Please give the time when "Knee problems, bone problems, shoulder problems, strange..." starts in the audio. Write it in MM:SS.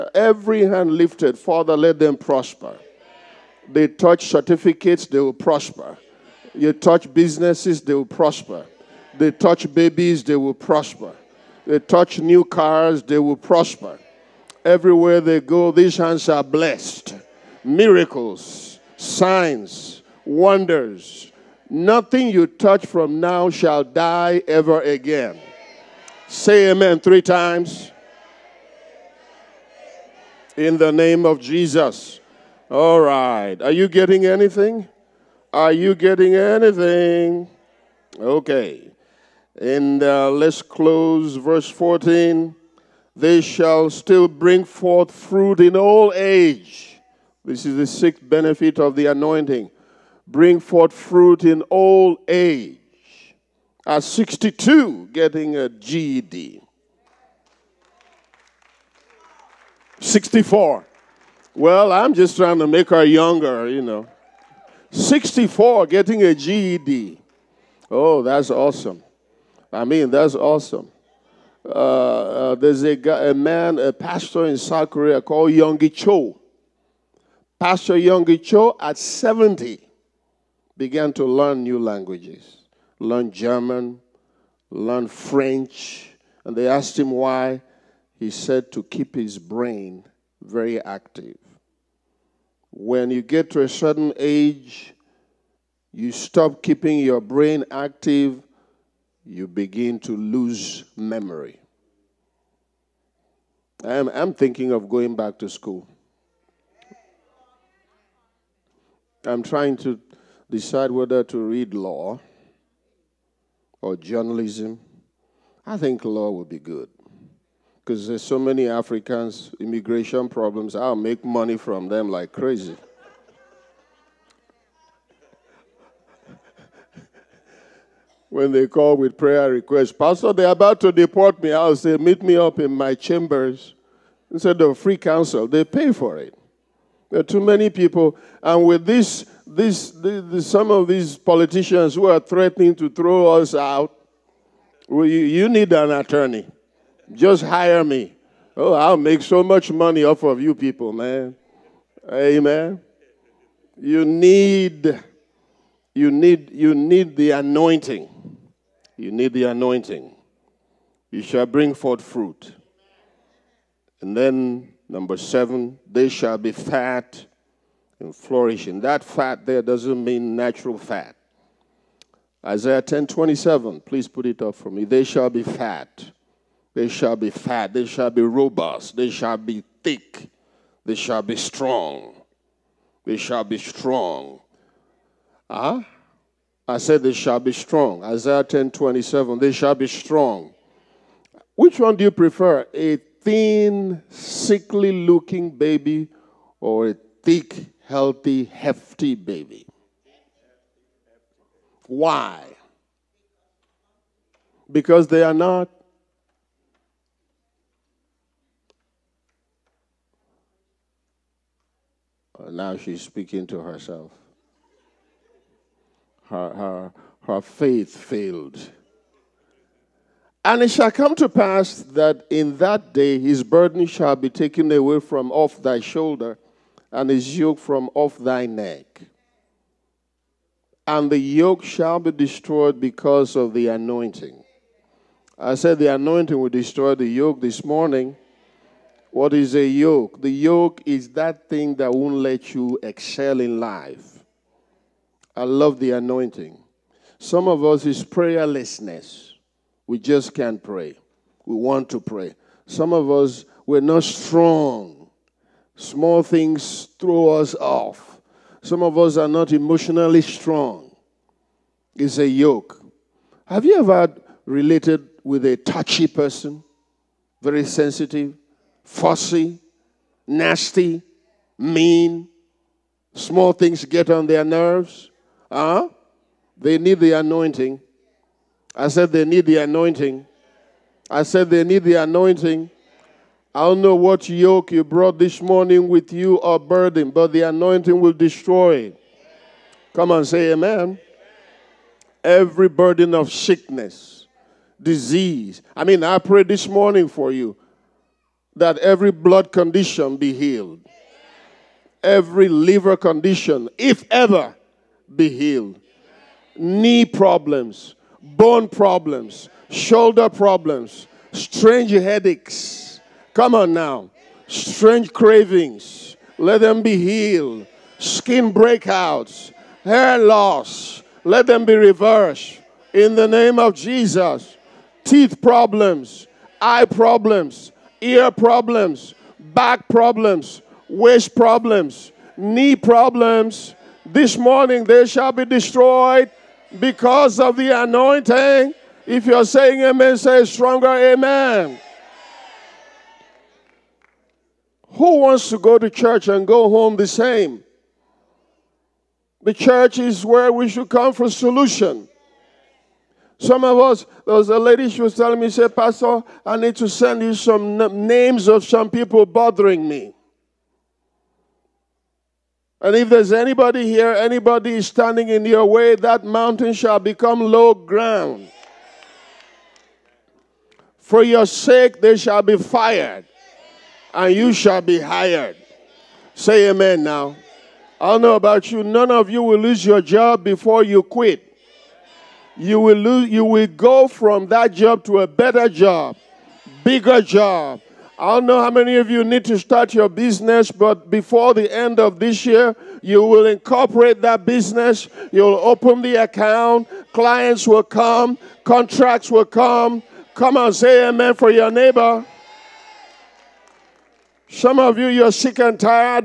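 05:06.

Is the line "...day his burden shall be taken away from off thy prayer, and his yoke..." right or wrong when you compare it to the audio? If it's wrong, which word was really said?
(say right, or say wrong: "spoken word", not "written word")
wrong: "shoulder", not "prayer".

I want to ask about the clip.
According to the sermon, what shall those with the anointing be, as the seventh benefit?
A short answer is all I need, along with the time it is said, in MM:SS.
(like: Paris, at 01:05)
Fat and flourishing, at 02:46.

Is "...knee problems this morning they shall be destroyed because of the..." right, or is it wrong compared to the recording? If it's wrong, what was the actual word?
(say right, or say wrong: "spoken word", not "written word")
right.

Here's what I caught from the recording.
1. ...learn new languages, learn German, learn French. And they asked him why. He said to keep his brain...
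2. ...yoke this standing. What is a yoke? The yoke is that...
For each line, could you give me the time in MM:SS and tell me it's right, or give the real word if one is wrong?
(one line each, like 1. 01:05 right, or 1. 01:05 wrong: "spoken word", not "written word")
1. 01:21 right
2. 03:57 wrong: "morning", not "standing".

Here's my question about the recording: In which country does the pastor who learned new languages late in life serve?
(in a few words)
South Korea.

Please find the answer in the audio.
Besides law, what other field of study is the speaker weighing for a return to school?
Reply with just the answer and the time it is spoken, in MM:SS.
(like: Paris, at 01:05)
Journalism, at 01:53.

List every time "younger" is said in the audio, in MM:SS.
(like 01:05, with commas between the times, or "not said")
01:03.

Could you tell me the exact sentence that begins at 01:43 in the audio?
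I'm, I'm thinking of going back to school.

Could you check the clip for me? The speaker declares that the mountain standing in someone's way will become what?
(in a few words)
Low ground.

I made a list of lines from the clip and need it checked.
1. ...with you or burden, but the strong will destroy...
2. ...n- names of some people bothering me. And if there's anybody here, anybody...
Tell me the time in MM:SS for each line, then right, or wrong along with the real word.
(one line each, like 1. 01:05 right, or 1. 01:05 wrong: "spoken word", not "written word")
1. 04:45 wrong: "anointing", not "strong"
2. 05:57 right.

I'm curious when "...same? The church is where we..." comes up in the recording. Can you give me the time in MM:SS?
05:47.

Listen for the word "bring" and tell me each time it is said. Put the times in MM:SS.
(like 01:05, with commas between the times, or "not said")
00:44, 00:50, 02:41.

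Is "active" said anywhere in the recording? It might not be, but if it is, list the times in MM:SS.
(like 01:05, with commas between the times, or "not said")
01:30, 01:37.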